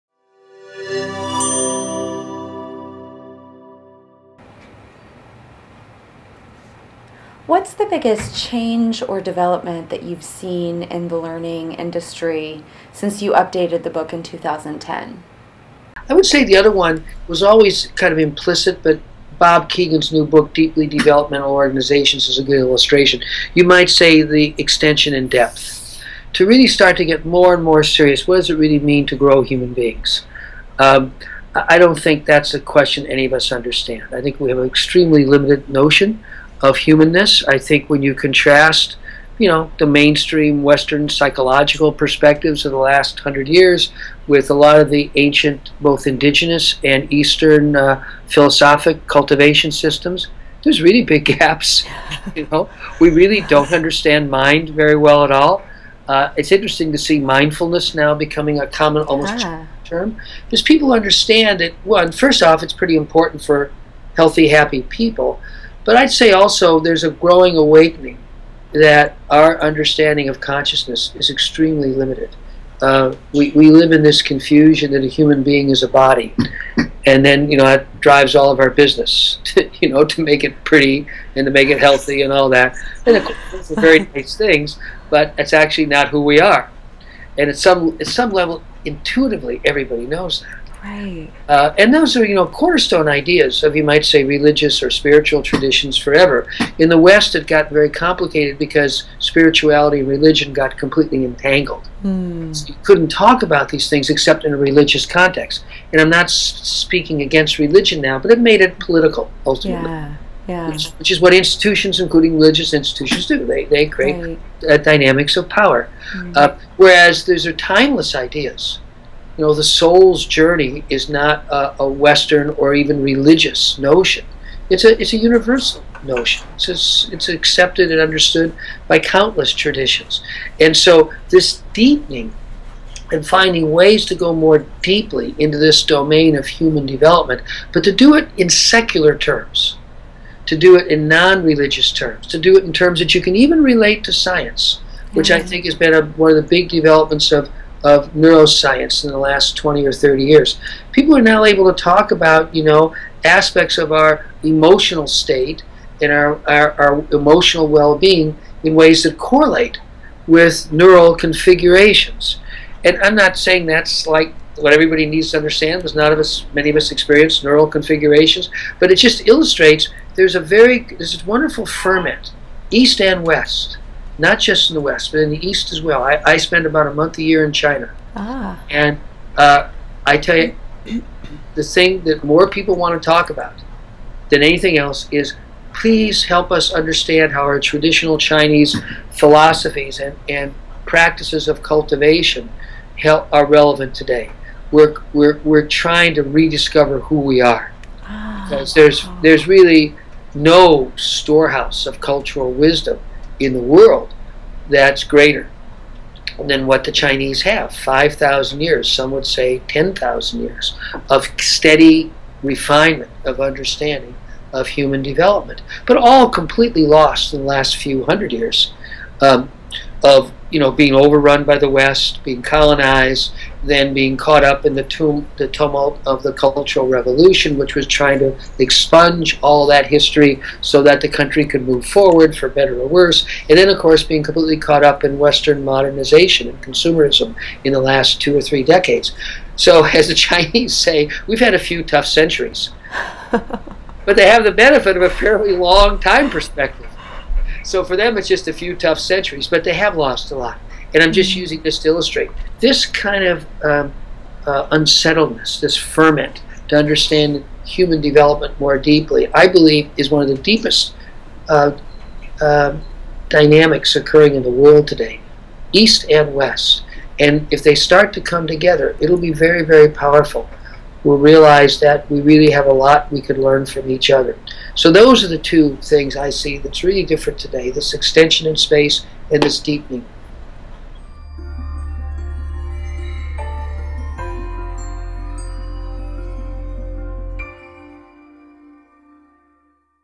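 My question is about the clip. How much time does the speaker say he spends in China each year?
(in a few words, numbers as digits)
About a month.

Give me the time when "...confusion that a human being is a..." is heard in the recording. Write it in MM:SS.
01:14.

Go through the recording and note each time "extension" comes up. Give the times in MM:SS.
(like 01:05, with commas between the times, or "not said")
00:24, 04:37.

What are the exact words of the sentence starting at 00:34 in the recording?
I think we have an extremely limited notion of humanness.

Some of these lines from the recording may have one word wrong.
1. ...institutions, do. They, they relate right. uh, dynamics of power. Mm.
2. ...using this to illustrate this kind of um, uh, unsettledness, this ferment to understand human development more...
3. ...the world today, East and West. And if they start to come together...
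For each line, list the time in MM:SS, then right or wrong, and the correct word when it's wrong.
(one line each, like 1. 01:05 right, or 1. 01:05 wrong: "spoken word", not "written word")
1. 01:52 wrong: "create", not "relate"
2. 04:11 right
3. 04:24 right.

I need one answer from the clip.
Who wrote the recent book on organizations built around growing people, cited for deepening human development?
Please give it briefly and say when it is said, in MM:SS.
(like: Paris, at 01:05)
Bob Kegan, at 00:19.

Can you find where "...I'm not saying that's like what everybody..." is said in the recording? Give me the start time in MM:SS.
02:43.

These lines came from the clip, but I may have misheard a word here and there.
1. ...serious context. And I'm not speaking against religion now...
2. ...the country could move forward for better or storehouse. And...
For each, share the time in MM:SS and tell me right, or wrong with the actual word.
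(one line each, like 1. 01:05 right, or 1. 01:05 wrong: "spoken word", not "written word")
1. 01:44 wrong: "religious", not "serious"
2. 03:51 wrong: "worse", not "storehouse".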